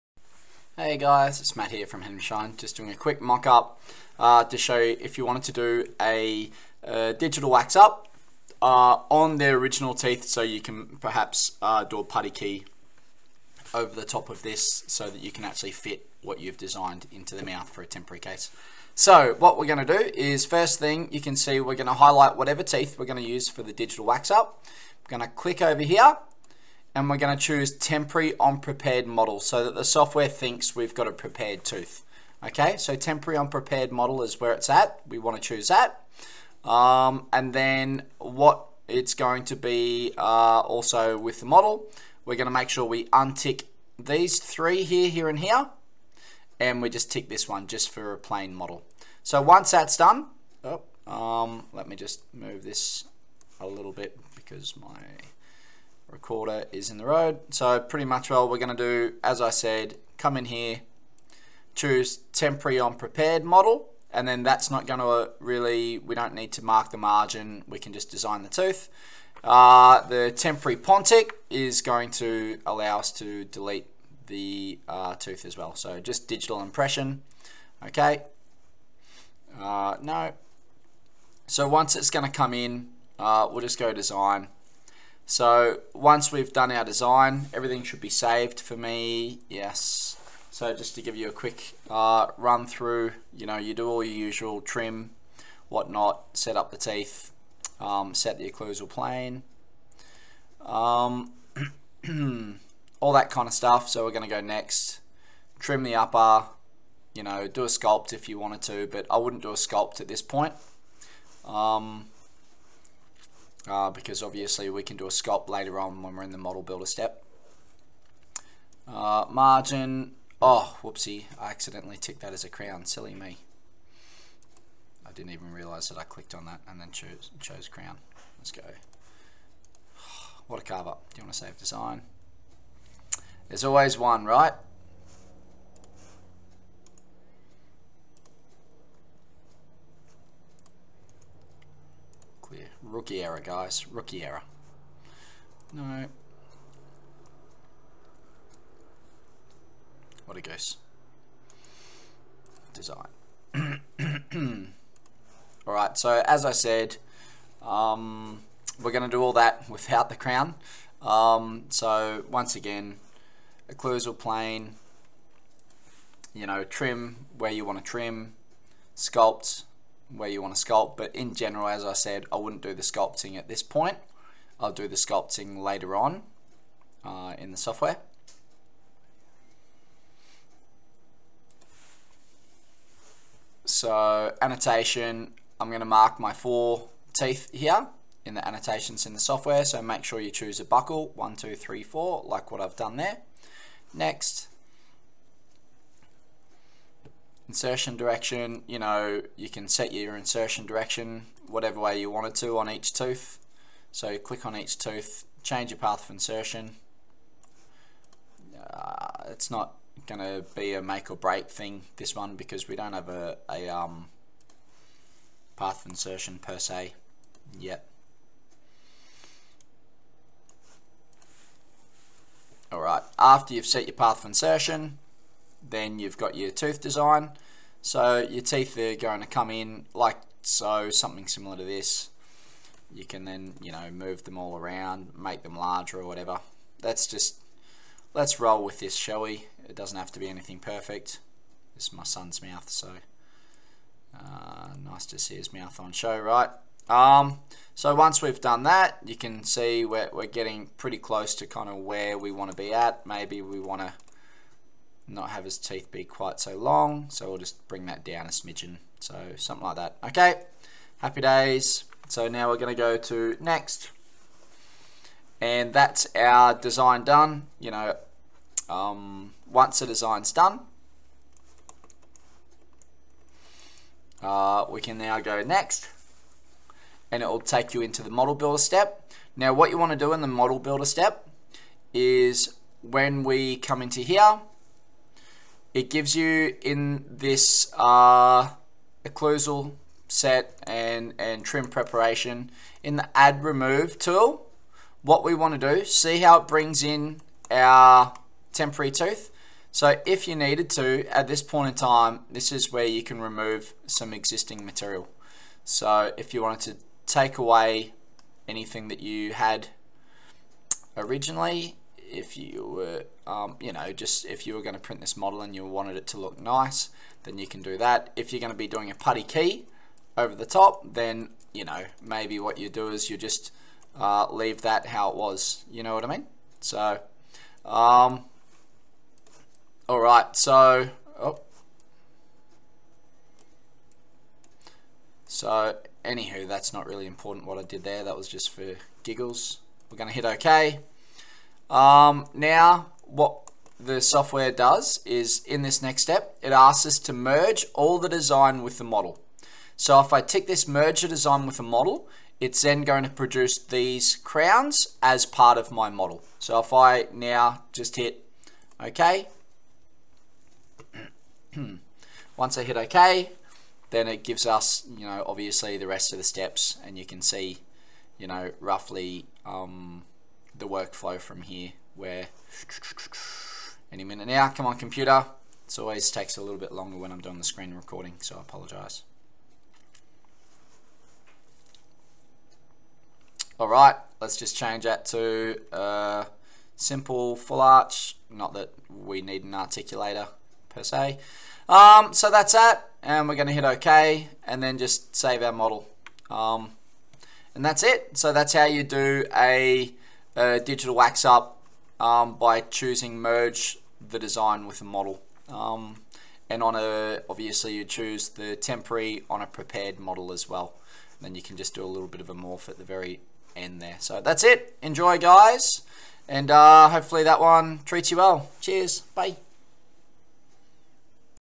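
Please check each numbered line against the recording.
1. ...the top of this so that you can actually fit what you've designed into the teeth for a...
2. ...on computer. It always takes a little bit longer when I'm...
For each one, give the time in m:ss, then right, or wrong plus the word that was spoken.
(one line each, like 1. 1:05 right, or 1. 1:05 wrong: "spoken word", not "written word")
1. 0:13 wrong: "mouth", not "teeth"
2. 6:14 right.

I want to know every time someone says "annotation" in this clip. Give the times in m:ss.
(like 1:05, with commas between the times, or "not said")
3:04, 3:08.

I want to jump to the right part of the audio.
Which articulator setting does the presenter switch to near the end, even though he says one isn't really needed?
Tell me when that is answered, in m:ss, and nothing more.
6:26.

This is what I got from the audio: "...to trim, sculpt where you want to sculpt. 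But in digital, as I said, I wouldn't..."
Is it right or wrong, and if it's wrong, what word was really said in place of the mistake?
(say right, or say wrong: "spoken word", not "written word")
wrong: "general", not "digital".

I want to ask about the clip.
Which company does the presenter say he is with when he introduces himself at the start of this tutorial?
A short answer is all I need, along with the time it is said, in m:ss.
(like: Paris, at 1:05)
Henry Schein, at 0:02.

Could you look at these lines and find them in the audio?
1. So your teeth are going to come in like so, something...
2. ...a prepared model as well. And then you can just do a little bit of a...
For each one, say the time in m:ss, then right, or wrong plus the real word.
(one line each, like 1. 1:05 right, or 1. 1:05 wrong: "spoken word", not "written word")
1. 3:47 right
2. 6:49 right.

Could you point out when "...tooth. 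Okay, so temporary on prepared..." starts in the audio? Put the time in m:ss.
0:31.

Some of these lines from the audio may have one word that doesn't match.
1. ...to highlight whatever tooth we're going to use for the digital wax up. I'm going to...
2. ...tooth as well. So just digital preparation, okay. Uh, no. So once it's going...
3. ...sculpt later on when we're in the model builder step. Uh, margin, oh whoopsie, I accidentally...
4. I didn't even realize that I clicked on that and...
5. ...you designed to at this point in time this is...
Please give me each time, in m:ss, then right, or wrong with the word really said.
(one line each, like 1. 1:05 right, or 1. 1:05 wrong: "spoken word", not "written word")
1. 0:21 wrong: "teeth", not "tooth"
2. 1:15 wrong: "impression", not "preparation"
3. 1:55 right
4. 2:05 right
5. 5:00 wrong: "needed", not "designed".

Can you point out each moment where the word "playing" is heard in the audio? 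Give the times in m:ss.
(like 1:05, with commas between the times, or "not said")
not said.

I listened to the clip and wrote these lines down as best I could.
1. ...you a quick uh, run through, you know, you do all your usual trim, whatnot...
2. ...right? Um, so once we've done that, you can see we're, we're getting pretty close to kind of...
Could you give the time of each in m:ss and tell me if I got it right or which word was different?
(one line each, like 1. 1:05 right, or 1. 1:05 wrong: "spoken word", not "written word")
1. 1:31 right
2. 4:06 right.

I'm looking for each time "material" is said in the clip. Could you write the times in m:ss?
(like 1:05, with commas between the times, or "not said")
5:04.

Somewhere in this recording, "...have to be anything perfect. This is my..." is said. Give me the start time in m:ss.
3:59.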